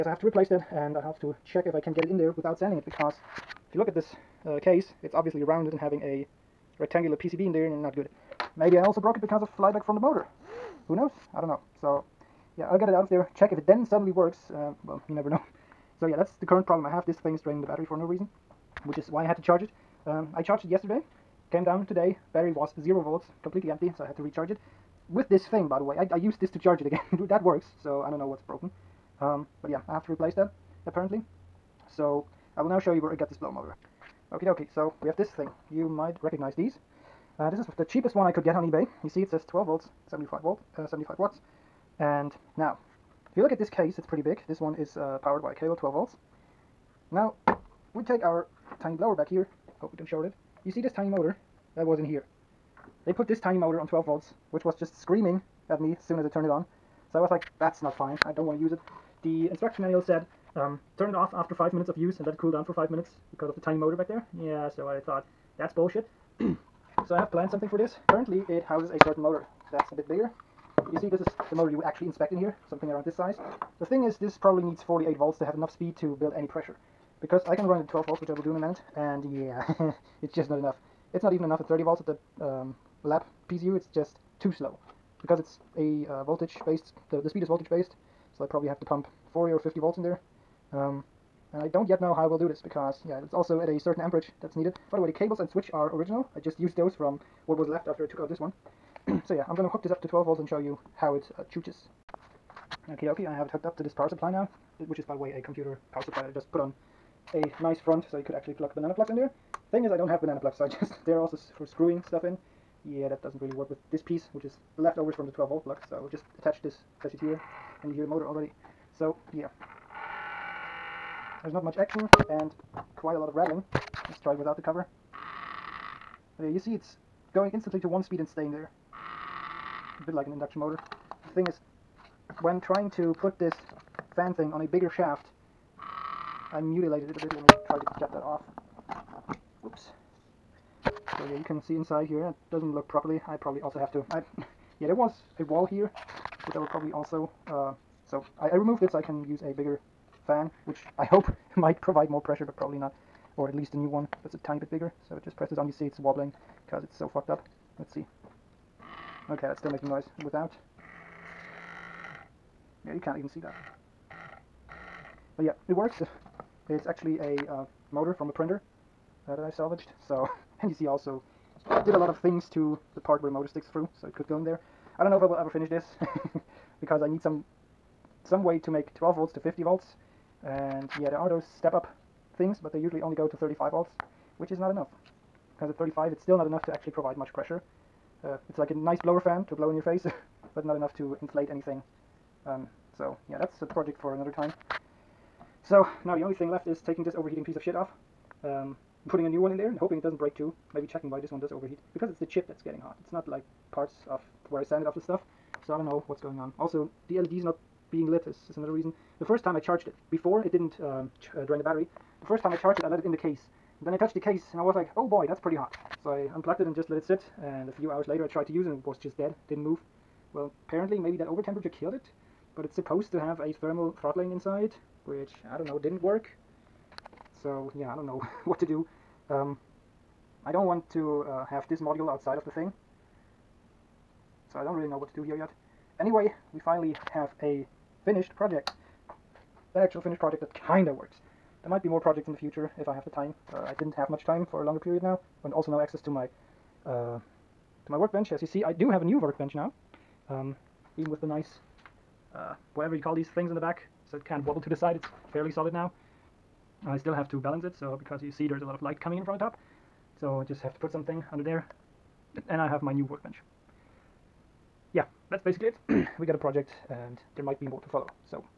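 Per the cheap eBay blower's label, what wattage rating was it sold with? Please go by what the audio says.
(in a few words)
75 watts.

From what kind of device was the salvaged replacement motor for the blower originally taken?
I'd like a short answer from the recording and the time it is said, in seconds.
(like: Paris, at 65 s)
a printer, at 168 s.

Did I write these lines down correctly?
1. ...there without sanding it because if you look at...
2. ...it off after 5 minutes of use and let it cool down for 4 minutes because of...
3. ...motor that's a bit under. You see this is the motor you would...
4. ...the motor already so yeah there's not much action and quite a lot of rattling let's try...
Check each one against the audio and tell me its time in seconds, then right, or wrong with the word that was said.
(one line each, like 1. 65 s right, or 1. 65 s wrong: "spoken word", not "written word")
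1. 2 s right
2. 61 s wrong: "5", not "4"
3. 69 s wrong: "bigger", not "under"
4. 118 s right.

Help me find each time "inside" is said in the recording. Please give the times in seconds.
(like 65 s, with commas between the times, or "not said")
141 s, 224 s.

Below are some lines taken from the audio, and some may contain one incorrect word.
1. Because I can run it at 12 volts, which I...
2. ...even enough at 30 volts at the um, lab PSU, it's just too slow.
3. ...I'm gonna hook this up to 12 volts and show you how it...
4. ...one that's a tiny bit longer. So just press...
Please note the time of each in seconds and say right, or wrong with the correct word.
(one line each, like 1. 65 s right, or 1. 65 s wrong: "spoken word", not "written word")
1. 77 s right
2. 81 s right
3. 99 s right
4. 153 s wrong: "bigger", not "longer".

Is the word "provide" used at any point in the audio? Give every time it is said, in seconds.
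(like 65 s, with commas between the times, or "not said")
151 s, 186 s.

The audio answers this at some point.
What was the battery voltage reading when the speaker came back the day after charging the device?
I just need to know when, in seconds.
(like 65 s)
22 s.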